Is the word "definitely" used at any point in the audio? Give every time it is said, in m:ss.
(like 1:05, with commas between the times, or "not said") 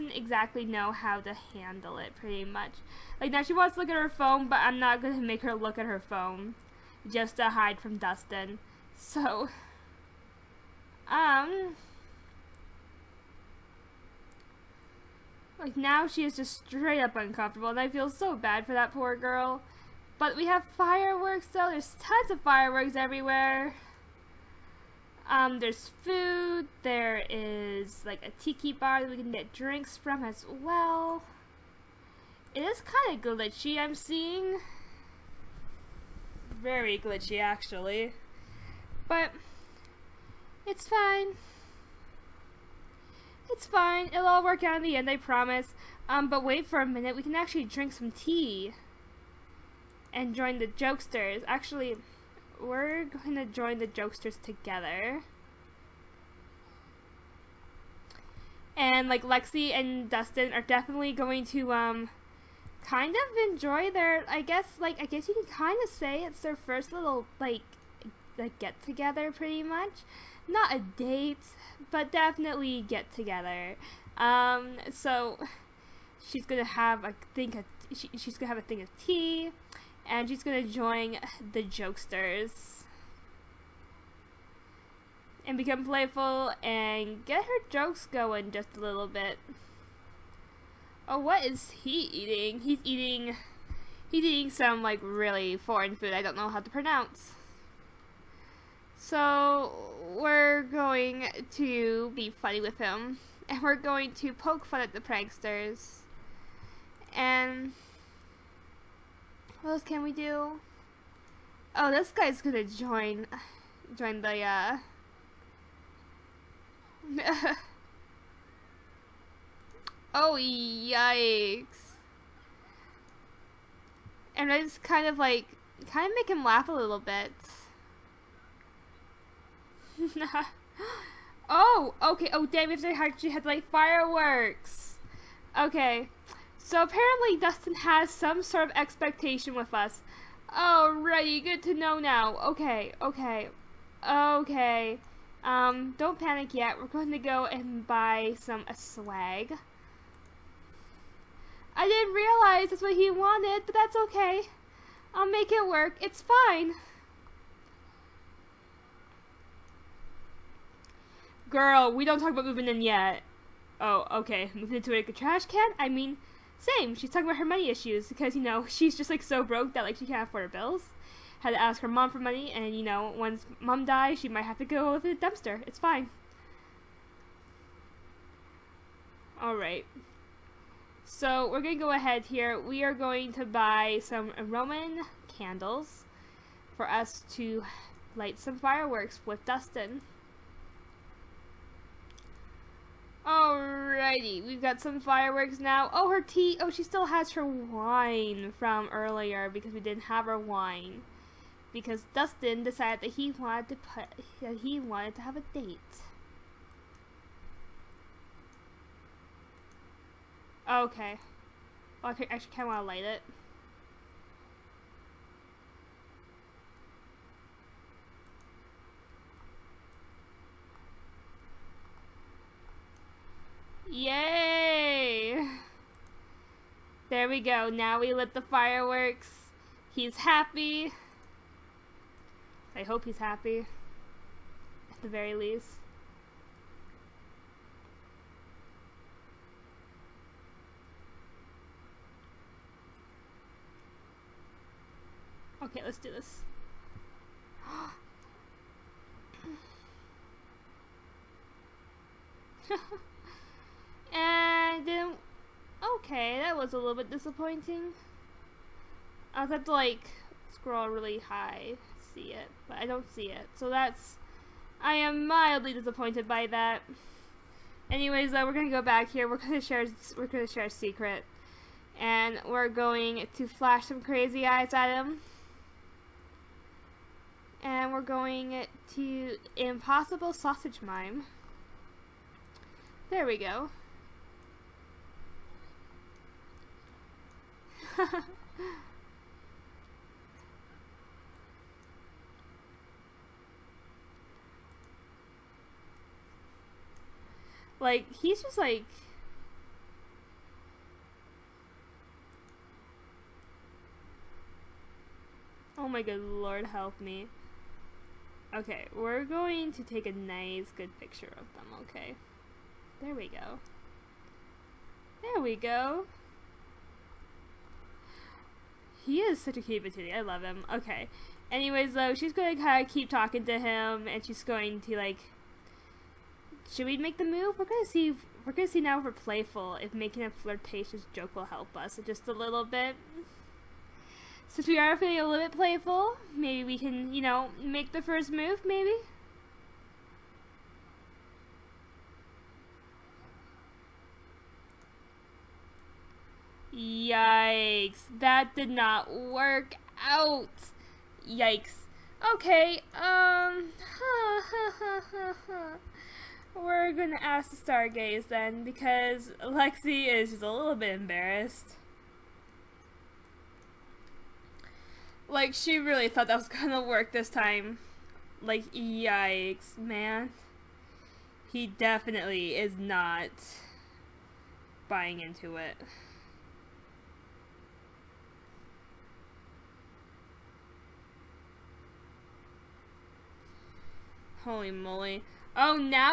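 1:00, 1:12, 6:11.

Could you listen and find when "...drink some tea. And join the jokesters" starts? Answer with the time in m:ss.
0:47.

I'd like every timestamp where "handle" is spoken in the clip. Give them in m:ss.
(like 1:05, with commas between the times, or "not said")
0:01.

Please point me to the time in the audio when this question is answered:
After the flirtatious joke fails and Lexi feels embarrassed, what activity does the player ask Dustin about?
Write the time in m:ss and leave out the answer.
5:57.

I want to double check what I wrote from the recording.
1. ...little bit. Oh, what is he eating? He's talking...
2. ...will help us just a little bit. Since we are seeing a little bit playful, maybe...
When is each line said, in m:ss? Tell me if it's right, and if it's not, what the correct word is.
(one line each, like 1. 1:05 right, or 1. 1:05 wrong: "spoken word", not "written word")
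1. 1:28 wrong: "eating", not "talking"
2. 5:31 wrong: "feeling", not "seeing".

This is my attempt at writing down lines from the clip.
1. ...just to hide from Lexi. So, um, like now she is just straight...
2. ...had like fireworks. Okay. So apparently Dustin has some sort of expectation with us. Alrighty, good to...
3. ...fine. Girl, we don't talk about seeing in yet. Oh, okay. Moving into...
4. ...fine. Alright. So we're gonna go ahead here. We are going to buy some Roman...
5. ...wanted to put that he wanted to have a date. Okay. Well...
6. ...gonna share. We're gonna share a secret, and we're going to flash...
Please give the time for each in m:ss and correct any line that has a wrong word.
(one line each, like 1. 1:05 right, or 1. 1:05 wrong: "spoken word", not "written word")
1. 0:07 wrong: "Dustin", not "Lexi"
2. 2:13 right
3. 2:36 wrong: "moving", not "seeing"
4. 2:55 right
5. 3:23 right
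6. 4:29 right.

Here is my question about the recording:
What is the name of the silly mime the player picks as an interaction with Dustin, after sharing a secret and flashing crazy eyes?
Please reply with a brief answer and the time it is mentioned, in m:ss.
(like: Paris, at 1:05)
Impossible Sausage Mime, at 4:39.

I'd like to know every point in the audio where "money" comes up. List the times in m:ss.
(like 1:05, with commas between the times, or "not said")
2:47, 2:52.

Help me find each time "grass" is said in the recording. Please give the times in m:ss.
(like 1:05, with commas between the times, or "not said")
not said.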